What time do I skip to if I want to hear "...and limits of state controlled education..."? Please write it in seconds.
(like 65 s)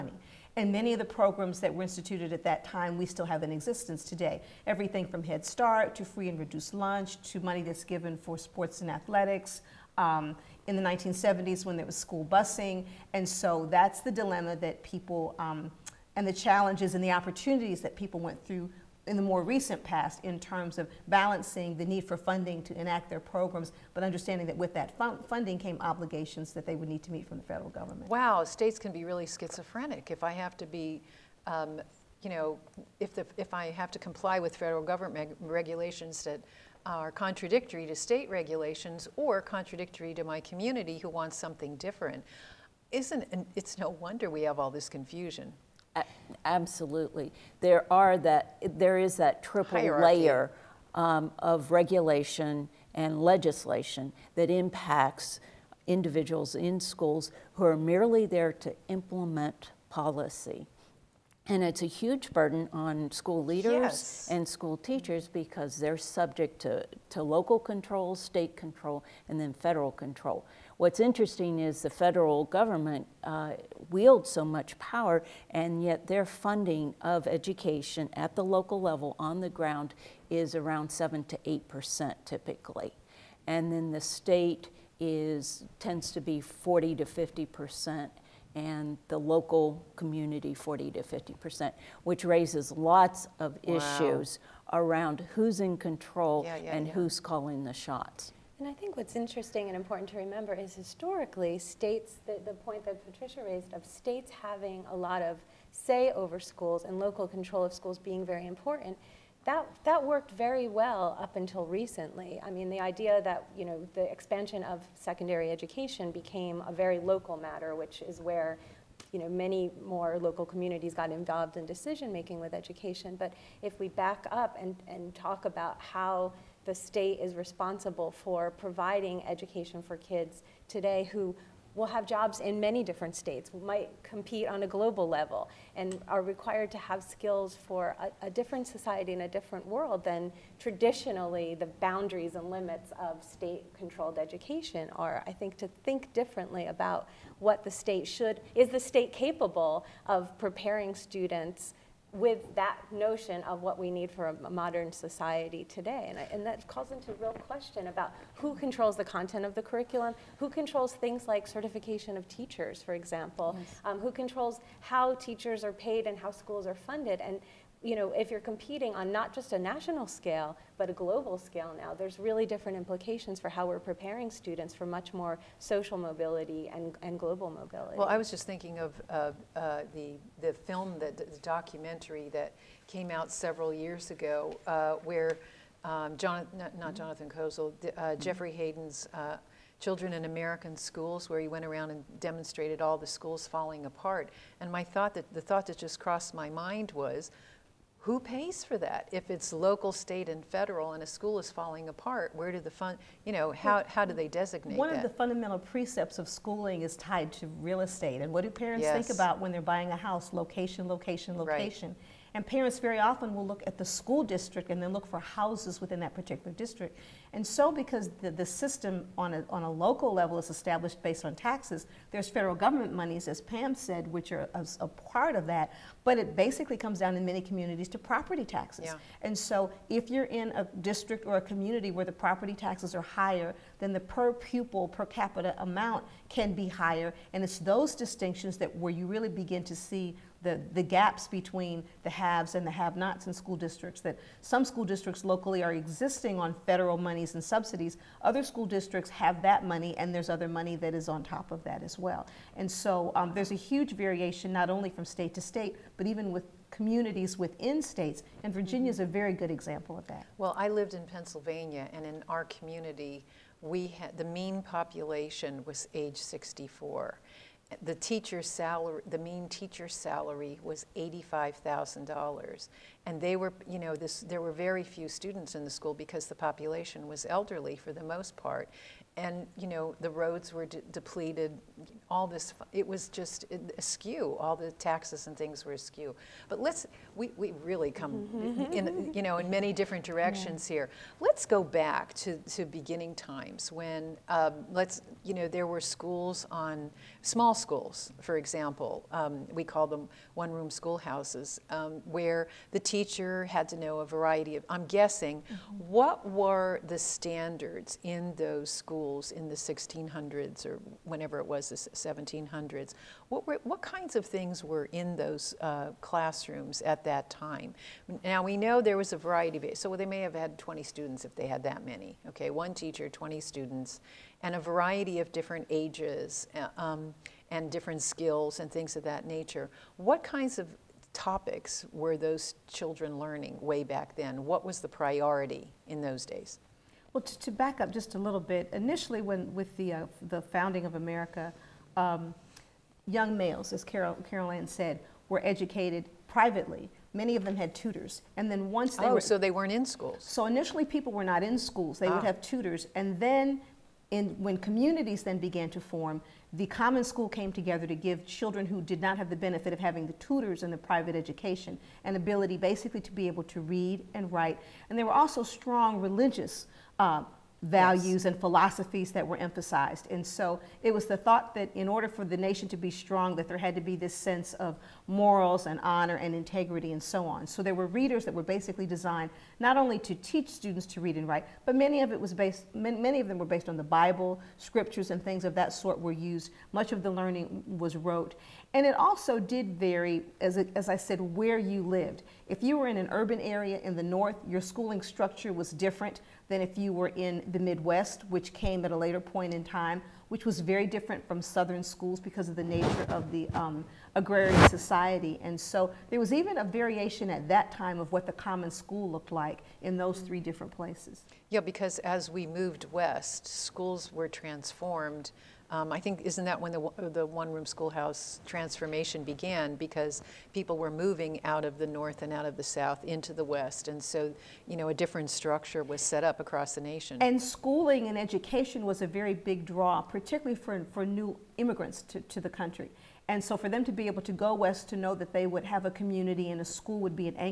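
142 s.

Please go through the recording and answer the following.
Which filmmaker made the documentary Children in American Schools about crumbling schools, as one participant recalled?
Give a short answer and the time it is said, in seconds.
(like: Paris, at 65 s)
Jeffrey Hayden, at 188 s.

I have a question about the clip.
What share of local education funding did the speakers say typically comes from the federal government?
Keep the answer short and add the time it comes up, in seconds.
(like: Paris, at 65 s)
7 to 8 percent, at 80 s.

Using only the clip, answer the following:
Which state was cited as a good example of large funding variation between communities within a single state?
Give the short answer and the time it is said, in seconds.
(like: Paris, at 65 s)
Virginia, at 258 s.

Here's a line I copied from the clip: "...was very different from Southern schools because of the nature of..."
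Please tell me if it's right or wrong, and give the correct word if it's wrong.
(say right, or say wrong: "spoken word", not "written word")
right.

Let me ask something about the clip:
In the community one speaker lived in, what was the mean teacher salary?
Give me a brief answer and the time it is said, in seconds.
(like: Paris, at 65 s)
$85,000, at 270 s.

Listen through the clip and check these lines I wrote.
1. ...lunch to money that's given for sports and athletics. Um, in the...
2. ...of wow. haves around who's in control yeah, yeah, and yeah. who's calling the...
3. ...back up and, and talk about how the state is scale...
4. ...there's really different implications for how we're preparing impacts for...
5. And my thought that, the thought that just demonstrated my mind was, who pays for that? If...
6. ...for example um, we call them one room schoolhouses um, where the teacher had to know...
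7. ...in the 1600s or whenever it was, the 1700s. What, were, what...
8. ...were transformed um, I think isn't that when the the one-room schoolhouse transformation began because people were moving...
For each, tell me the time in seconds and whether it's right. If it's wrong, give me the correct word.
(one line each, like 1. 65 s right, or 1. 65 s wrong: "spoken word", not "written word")
1. 6 s right
2. 93 s wrong: "issues", not "haves"
3. 123 s wrong: "responsible", not "scale"
4. 171 s wrong: "students", not "impacts"
5. 194 s wrong: "crossed", not "demonstrated"
6. 298 s right
7. 309 s right
8. 414 s right.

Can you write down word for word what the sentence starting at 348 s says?
And then once they oh, were, so they weren't in schools.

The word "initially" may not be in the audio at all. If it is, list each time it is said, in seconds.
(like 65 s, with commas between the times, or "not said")
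338 s, 350 s.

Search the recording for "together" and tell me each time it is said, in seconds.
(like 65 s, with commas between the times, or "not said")
357 s.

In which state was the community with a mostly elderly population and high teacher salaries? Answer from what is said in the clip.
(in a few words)
Pennsylvania.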